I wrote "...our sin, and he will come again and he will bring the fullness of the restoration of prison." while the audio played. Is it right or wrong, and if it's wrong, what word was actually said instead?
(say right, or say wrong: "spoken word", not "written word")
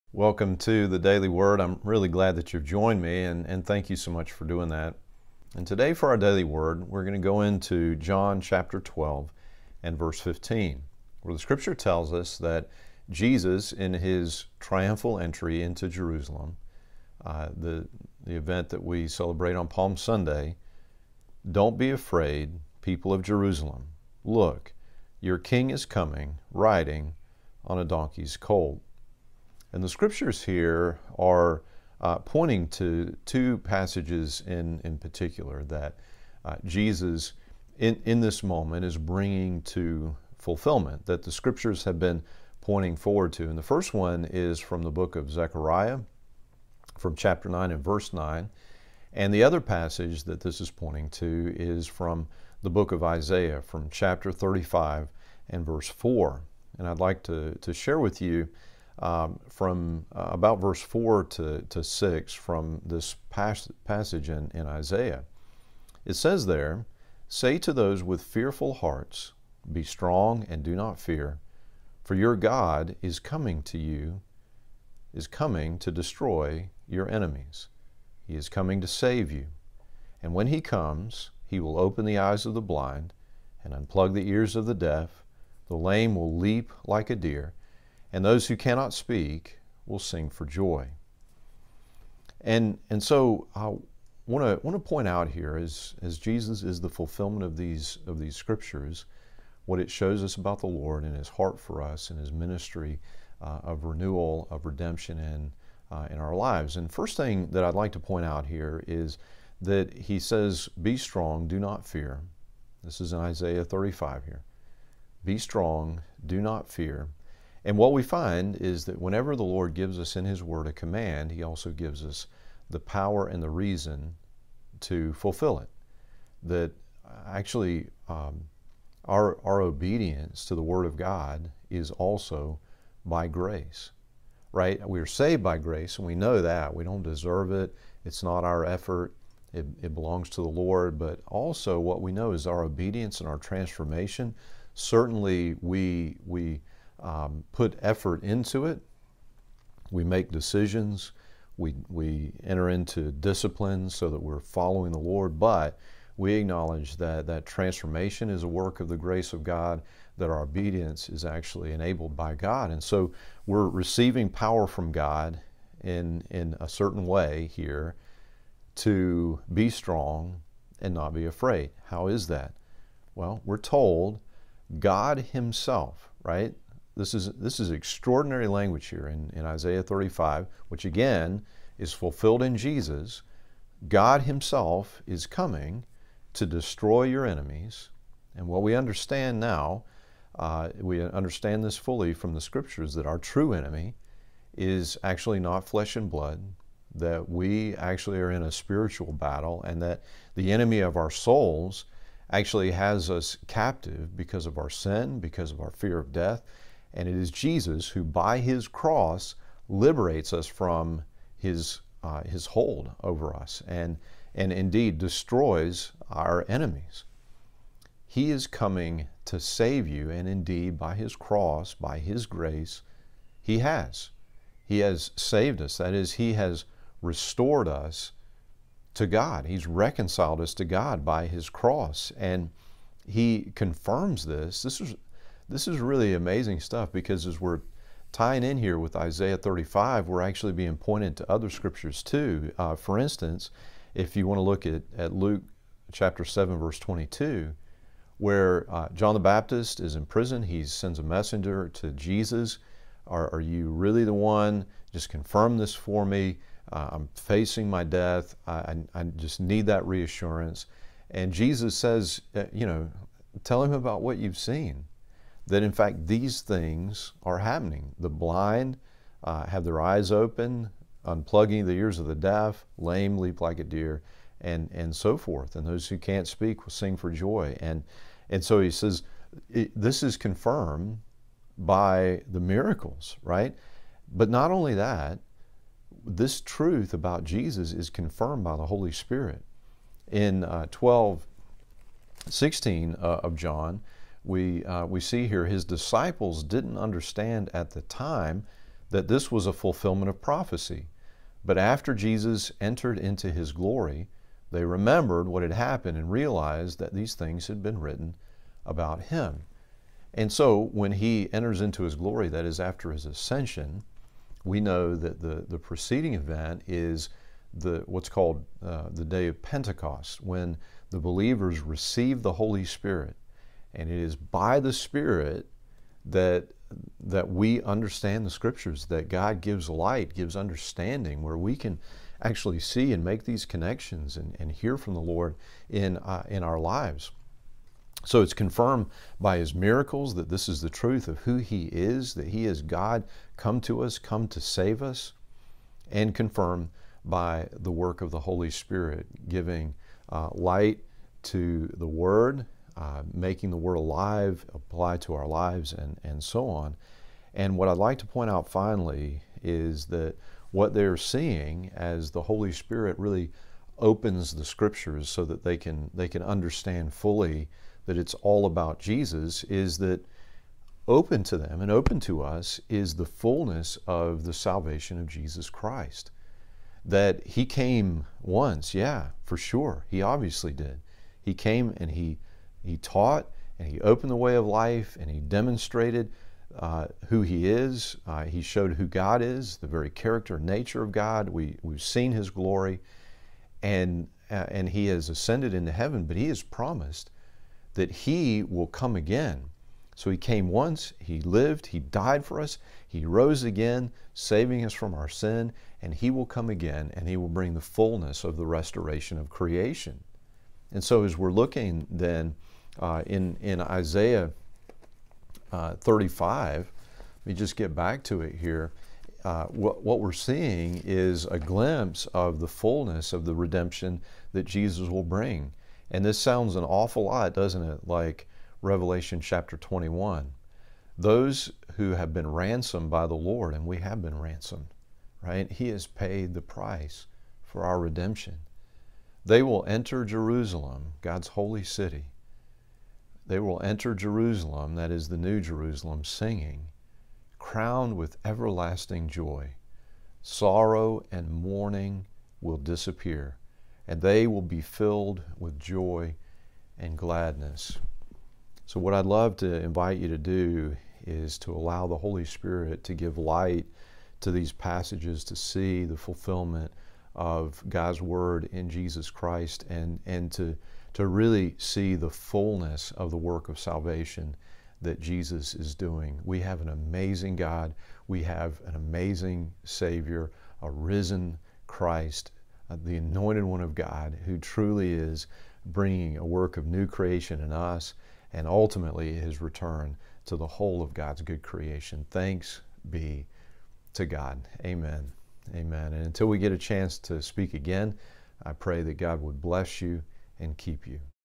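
wrong: "creation", not "prison".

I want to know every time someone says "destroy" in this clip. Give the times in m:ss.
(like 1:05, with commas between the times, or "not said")
1:15, 3:06, 3:34.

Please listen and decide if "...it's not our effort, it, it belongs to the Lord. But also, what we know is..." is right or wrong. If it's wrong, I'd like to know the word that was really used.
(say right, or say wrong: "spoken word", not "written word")
right.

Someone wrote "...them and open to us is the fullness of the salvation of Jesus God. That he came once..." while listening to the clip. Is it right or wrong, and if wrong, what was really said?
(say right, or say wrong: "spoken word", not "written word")
wrong: "Christ", not "God".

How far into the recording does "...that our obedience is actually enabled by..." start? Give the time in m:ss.
2:40.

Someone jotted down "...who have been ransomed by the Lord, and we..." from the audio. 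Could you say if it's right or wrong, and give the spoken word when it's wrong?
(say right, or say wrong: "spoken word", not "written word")
right.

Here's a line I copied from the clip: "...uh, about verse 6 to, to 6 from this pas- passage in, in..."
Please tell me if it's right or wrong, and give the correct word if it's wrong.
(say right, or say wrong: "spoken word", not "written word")
wrong: "4", not "6".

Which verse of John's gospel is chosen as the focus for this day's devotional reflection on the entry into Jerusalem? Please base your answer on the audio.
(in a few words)
John 12:15.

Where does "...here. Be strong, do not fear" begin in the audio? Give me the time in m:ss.
1:54.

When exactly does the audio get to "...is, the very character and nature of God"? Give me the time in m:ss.
6:29.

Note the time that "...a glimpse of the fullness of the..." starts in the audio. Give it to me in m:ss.
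7:01.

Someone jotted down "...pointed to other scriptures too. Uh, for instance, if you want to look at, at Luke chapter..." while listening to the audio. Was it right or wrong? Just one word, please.
right.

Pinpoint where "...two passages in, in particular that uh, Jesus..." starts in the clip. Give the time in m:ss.
0:33.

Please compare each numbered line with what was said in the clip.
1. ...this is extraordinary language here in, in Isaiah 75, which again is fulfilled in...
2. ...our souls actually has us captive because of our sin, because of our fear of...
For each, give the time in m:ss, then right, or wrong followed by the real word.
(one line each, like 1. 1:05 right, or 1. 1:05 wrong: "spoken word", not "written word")
1. 2:57 wrong: "35", not "75"
2. 3:20 right.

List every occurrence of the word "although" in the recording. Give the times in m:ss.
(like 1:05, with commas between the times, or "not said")
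not said.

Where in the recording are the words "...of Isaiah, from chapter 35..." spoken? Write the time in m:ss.
0:52.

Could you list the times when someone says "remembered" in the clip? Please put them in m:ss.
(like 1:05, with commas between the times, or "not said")
5:04.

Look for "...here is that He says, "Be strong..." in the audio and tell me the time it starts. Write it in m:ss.
1:48.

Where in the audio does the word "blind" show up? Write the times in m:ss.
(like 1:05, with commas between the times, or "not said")
1:22, 4:28.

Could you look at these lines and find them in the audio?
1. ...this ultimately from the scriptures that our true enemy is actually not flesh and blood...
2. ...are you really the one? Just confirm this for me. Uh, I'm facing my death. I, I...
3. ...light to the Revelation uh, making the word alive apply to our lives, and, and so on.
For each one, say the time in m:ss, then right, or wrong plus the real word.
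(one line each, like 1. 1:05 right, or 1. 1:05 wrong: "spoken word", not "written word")
1. 3:11 wrong: "fully", not "ultimately"
2. 4:13 right
3. 5:50 wrong: "Word", not "Revelation".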